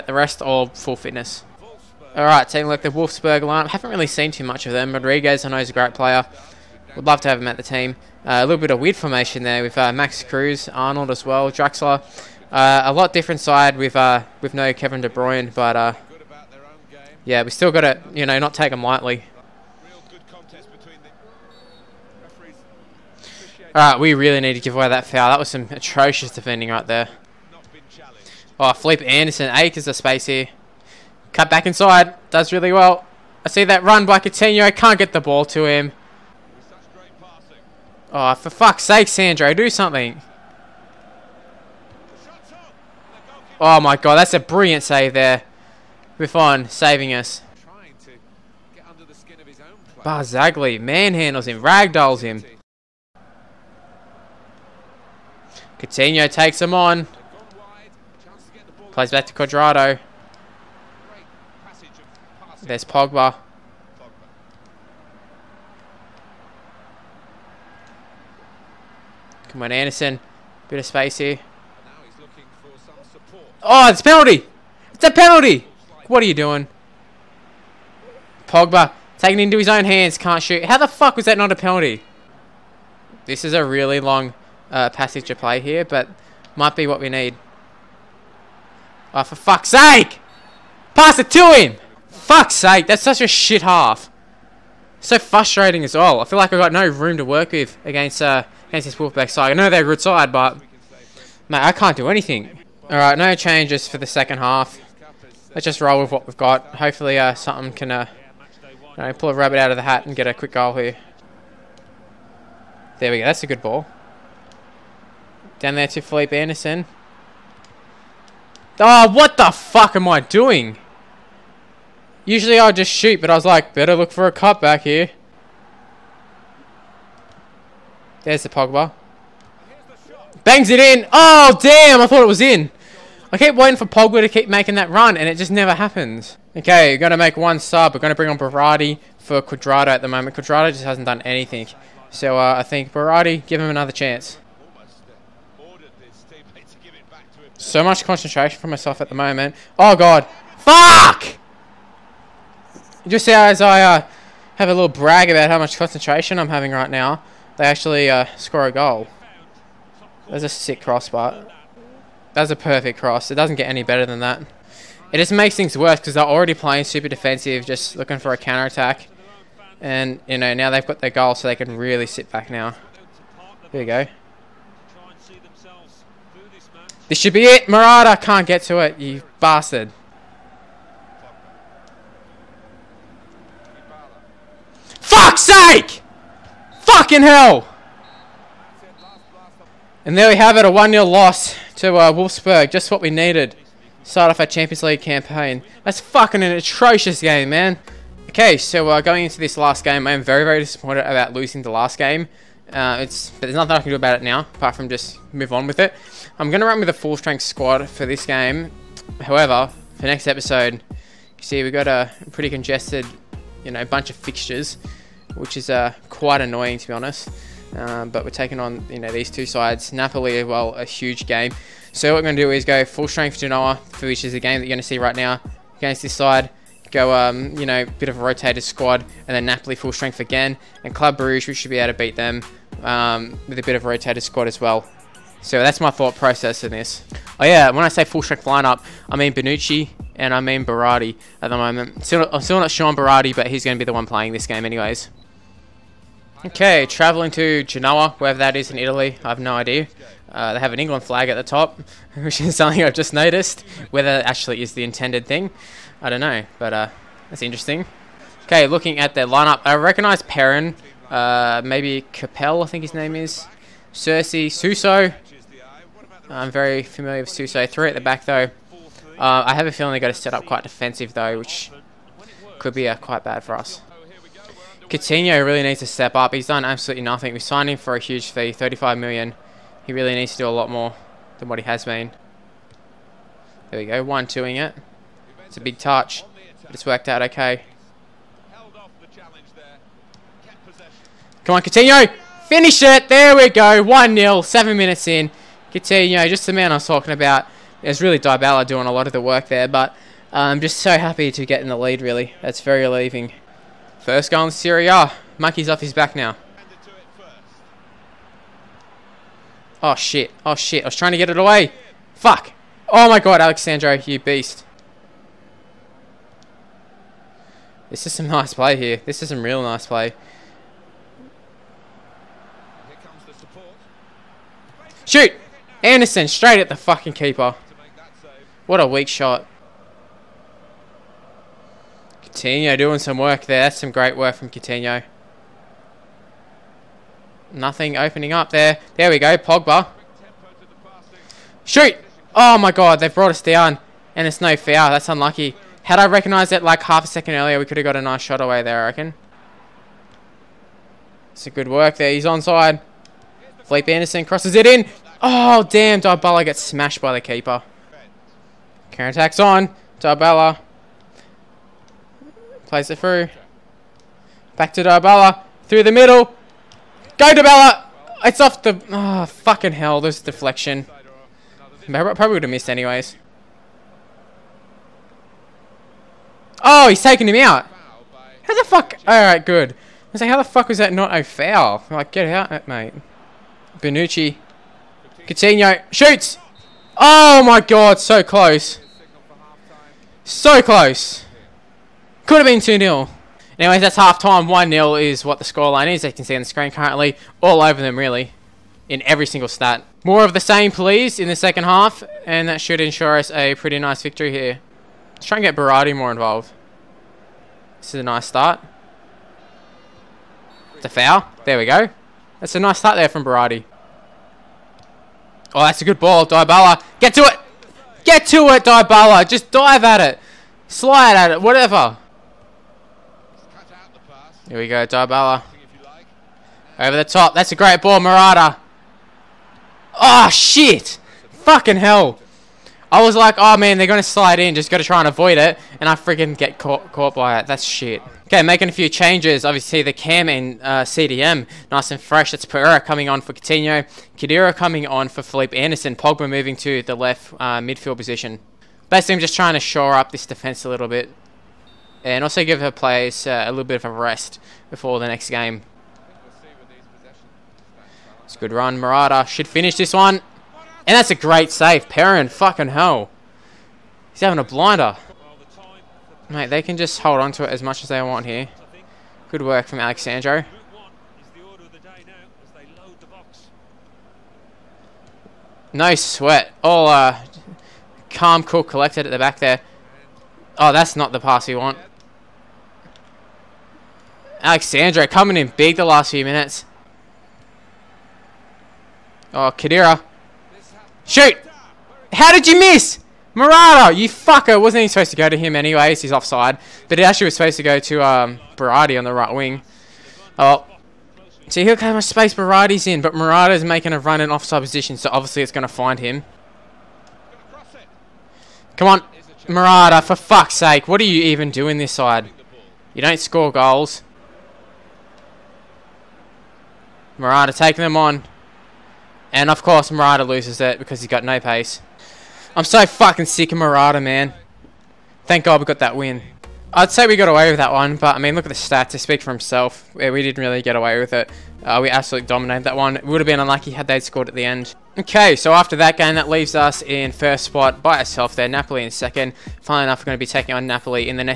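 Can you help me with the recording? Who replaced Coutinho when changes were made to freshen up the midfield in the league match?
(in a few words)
Pereira.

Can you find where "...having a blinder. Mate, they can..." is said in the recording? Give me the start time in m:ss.
7:44.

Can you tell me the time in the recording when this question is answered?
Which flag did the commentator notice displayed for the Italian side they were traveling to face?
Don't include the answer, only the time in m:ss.
4:10.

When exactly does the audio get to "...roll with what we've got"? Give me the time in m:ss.
1:45.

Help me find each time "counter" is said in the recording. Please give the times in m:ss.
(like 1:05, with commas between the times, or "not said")
2:48, 5:58.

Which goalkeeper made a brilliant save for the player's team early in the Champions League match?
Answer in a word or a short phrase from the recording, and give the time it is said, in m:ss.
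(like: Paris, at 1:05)
Buffon, at 0:46.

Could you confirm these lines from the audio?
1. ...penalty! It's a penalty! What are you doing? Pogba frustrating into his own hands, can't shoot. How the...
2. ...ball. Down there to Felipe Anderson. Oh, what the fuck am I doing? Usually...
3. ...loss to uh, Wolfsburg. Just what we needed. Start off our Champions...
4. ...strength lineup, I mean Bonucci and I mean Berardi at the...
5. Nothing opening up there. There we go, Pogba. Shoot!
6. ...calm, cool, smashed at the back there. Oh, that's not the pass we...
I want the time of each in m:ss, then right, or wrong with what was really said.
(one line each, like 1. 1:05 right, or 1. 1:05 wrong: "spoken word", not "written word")
1. 1:14 wrong: "taking", not "frustrating"
2. 1:53 right
3. 3:11 right
4. 3:58 right
5. 5:37 right
6. 7:58 wrong: "collected", not "smashed".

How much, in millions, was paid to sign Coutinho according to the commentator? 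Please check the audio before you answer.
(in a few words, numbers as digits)
35 million.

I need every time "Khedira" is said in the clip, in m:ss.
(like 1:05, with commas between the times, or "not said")
7:24, 8:09.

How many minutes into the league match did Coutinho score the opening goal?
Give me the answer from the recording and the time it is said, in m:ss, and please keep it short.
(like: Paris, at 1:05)
7 minutes, at 4:54.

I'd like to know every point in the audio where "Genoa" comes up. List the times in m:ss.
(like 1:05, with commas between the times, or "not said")
3:43, 4:07.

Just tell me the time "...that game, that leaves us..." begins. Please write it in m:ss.
8:55.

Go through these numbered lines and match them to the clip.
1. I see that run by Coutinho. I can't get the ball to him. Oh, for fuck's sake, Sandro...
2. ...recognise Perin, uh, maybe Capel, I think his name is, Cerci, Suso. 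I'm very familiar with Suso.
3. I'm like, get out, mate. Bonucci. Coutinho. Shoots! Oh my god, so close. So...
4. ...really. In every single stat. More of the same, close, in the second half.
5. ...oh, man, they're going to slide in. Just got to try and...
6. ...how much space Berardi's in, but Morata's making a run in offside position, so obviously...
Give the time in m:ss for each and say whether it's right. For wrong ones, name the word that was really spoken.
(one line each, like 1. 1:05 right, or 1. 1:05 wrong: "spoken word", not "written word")
1. 0:33 right
2. 4:19 right
3. 6:21 right
4. 6:37 wrong: "please", not "close"
5. 7:13 right
6. 8:21 right.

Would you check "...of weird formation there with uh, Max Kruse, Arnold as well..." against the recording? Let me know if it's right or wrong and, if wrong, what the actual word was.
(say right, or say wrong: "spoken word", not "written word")
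right.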